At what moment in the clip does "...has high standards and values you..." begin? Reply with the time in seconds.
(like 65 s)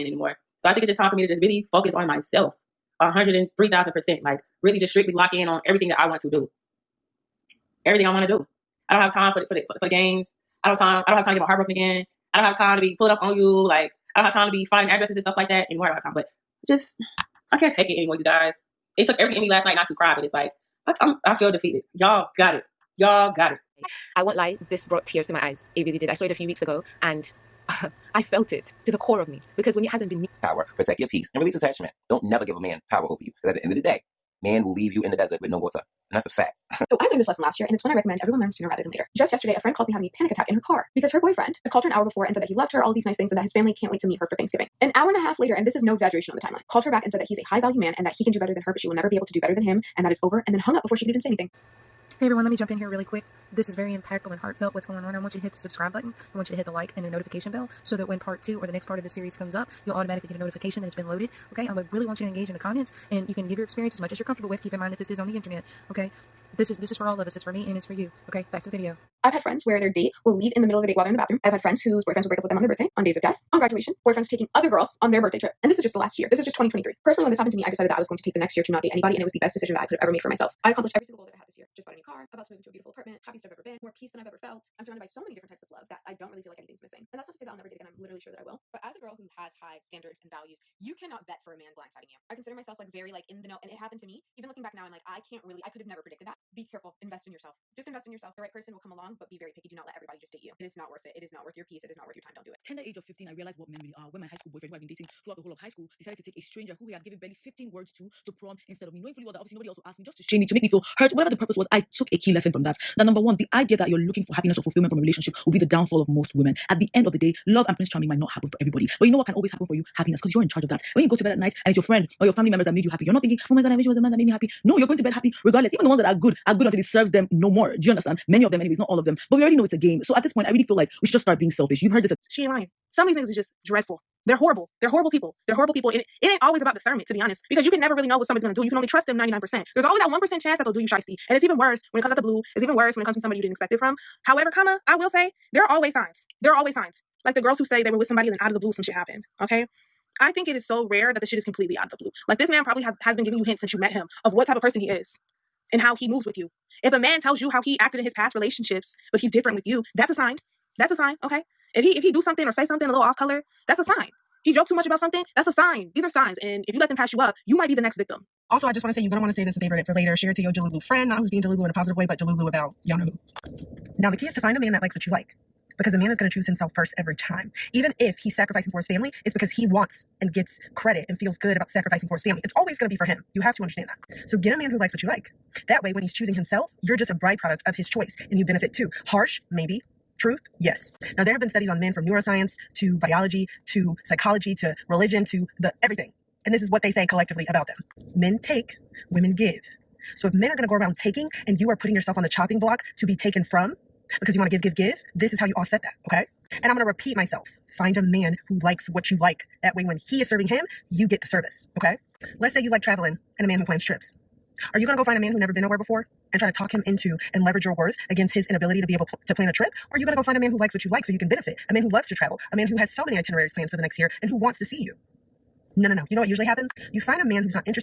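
89 s.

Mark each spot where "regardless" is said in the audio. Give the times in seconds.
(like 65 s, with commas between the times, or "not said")
125 s.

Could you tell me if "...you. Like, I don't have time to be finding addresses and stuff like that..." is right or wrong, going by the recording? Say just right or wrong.
right.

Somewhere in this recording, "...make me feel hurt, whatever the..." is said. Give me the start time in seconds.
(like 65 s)
110 s.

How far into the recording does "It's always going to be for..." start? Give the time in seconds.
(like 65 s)
182 s.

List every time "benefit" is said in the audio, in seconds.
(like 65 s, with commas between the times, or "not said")
188 s, 221 s.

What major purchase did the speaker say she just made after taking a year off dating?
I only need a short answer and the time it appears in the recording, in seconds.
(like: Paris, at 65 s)
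A new car, at 81 s.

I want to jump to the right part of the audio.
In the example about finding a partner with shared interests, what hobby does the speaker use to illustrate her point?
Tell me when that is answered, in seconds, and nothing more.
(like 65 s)
212 s.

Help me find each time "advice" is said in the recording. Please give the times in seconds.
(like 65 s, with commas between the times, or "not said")
not said.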